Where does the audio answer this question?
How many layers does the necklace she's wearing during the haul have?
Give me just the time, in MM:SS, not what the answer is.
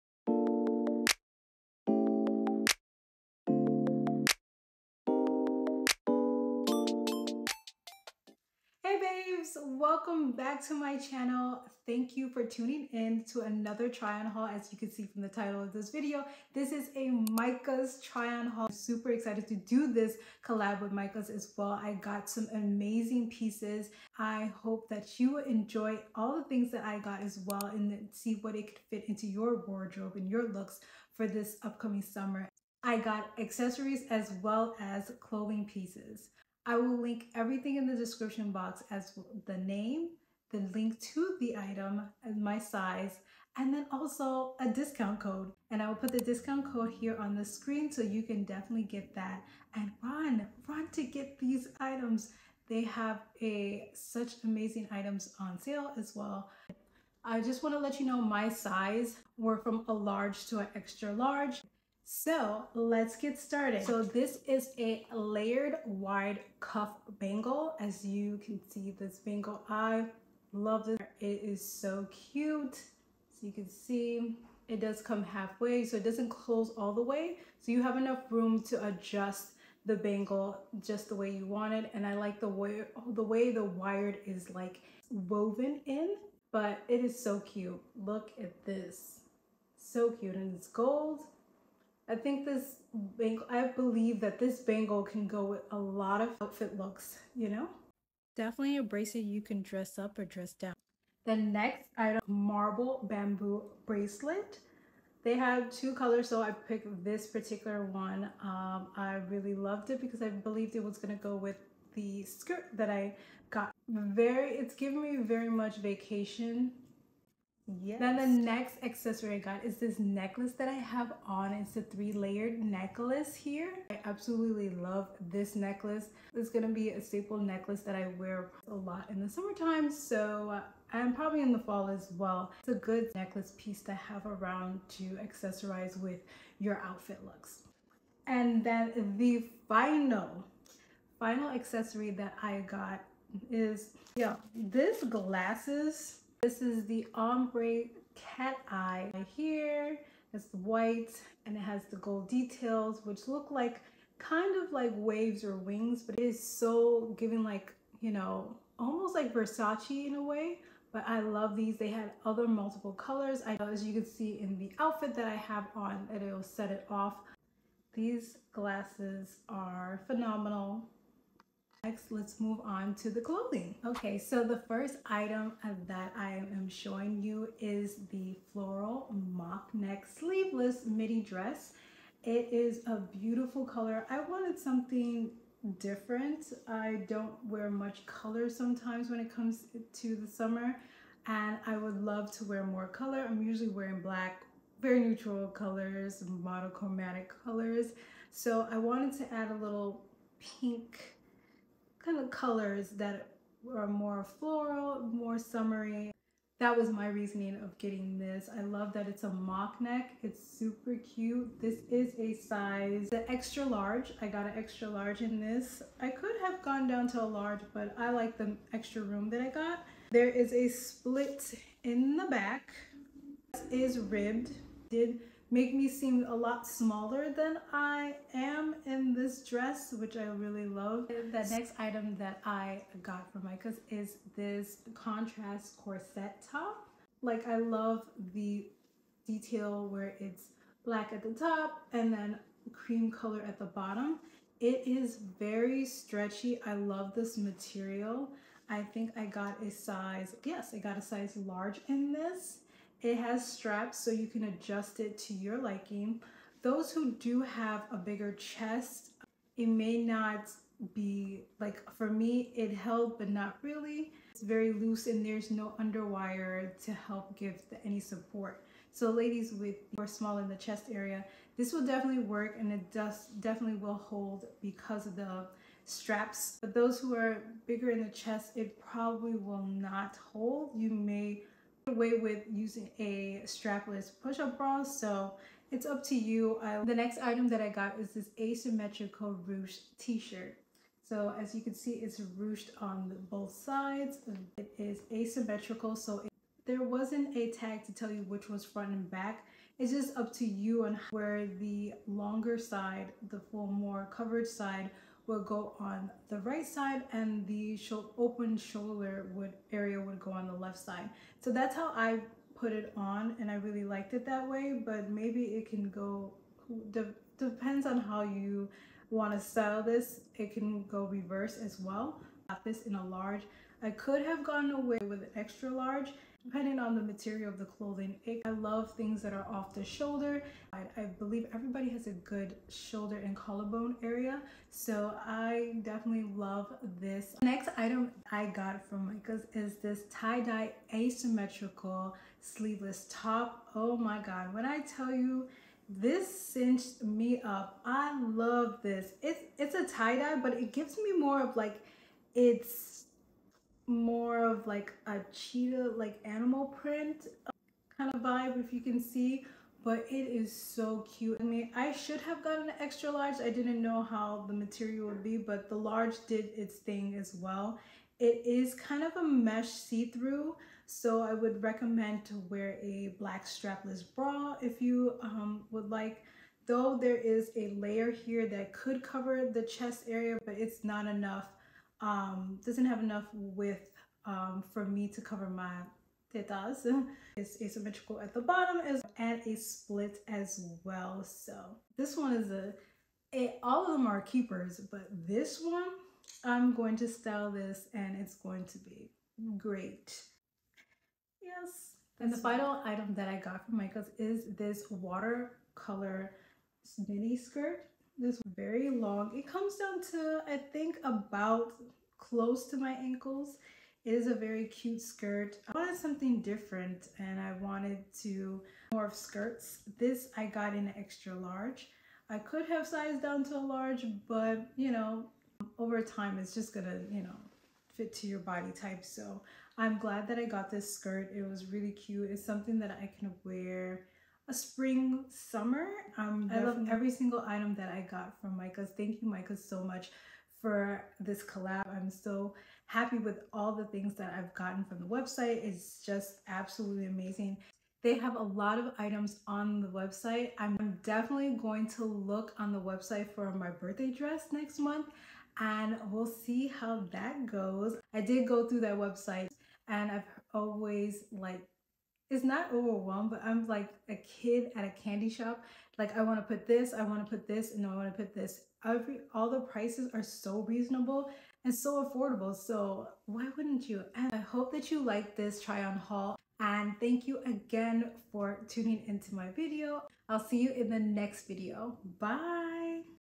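02:01.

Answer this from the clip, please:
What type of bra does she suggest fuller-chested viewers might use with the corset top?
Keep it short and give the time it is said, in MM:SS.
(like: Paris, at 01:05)
strapless push-up bra, at 04:43.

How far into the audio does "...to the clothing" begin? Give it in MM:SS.
02:53.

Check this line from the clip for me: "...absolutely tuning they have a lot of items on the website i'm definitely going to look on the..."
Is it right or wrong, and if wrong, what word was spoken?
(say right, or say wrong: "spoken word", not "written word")
wrong: "amazing", not "tuning".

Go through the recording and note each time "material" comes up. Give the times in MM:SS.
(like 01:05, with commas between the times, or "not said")
04:07, 05:27, 06:04.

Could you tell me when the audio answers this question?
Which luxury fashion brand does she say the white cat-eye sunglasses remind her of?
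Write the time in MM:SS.
02:39.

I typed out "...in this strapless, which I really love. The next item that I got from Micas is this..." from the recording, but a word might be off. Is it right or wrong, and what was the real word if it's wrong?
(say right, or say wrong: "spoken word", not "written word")
wrong: "dress", not "strapless".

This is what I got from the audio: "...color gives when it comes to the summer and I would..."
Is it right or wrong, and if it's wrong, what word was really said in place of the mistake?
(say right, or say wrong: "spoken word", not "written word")
wrong: "sometimes", not "gives".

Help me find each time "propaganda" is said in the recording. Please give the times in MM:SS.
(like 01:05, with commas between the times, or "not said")
not said.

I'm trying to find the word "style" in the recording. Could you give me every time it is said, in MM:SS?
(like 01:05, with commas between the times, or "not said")
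05:19, 06:37.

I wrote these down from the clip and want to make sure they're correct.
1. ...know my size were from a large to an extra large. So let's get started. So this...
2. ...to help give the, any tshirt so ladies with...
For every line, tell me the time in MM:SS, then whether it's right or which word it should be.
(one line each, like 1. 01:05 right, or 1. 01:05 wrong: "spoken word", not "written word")
1. 00:58 right
2. 04:26 wrong: "support", not "tshirt".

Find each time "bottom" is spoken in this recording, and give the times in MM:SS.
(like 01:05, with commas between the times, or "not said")
04:03, 06:28.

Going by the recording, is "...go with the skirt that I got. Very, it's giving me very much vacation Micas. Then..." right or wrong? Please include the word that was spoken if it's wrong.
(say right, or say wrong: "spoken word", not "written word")
wrong: "Yes", not "Micas".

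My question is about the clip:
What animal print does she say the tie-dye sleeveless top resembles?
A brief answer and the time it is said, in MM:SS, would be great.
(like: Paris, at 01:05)
cheetah, at 05:55.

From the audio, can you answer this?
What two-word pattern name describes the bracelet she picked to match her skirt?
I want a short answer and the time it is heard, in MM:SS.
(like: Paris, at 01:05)
marble bamboo, at 01:42.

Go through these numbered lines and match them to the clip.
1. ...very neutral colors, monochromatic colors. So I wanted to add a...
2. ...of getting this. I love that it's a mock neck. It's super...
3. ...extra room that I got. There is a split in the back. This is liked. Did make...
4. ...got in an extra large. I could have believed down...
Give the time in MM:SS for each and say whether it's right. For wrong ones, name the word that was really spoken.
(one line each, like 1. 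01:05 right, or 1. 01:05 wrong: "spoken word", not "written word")
1. 03:14 right
2. 03:27 right
3. 03:38 wrong: "ribbed", not "liked"
4. 07:00 wrong: "sized", not "believed".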